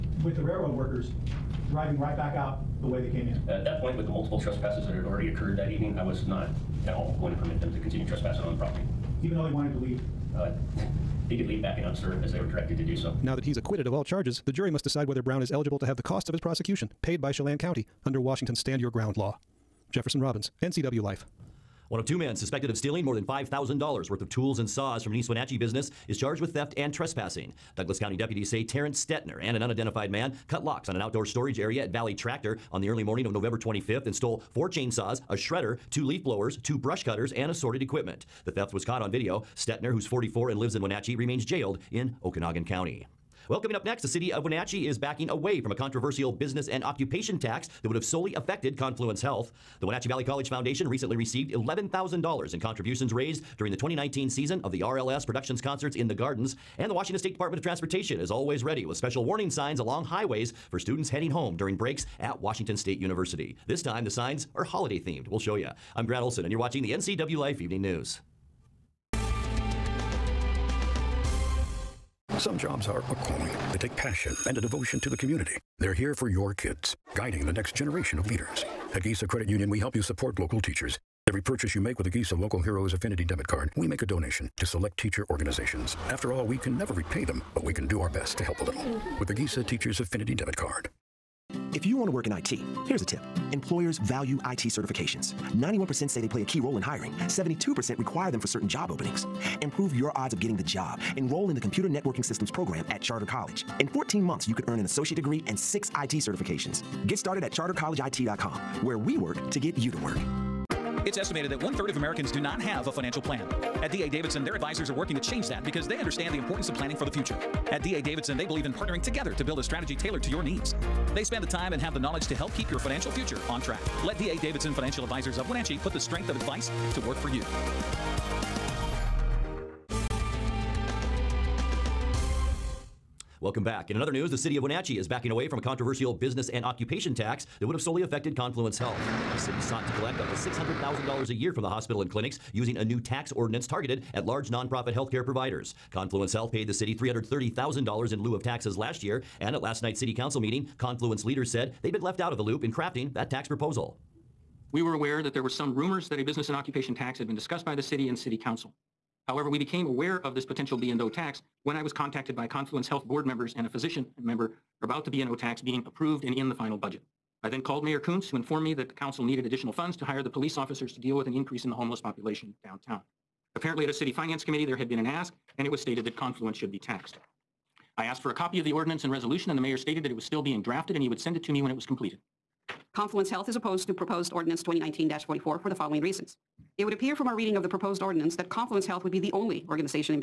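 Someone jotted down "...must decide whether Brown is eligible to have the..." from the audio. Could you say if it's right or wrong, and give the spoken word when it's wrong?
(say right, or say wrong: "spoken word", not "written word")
right.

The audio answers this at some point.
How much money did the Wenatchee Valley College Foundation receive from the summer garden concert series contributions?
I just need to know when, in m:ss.
0:51.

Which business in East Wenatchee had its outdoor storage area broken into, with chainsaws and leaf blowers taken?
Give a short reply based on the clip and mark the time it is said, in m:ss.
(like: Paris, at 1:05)
Valley Tractor, at 0:31.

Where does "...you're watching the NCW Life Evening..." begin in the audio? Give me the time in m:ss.
1:06.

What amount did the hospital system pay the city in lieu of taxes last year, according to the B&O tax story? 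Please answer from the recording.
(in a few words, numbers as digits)
$330,000.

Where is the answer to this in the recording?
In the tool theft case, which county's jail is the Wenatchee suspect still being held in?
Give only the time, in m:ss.
0:42.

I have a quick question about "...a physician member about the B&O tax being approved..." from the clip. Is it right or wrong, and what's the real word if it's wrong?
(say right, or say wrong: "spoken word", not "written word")
right.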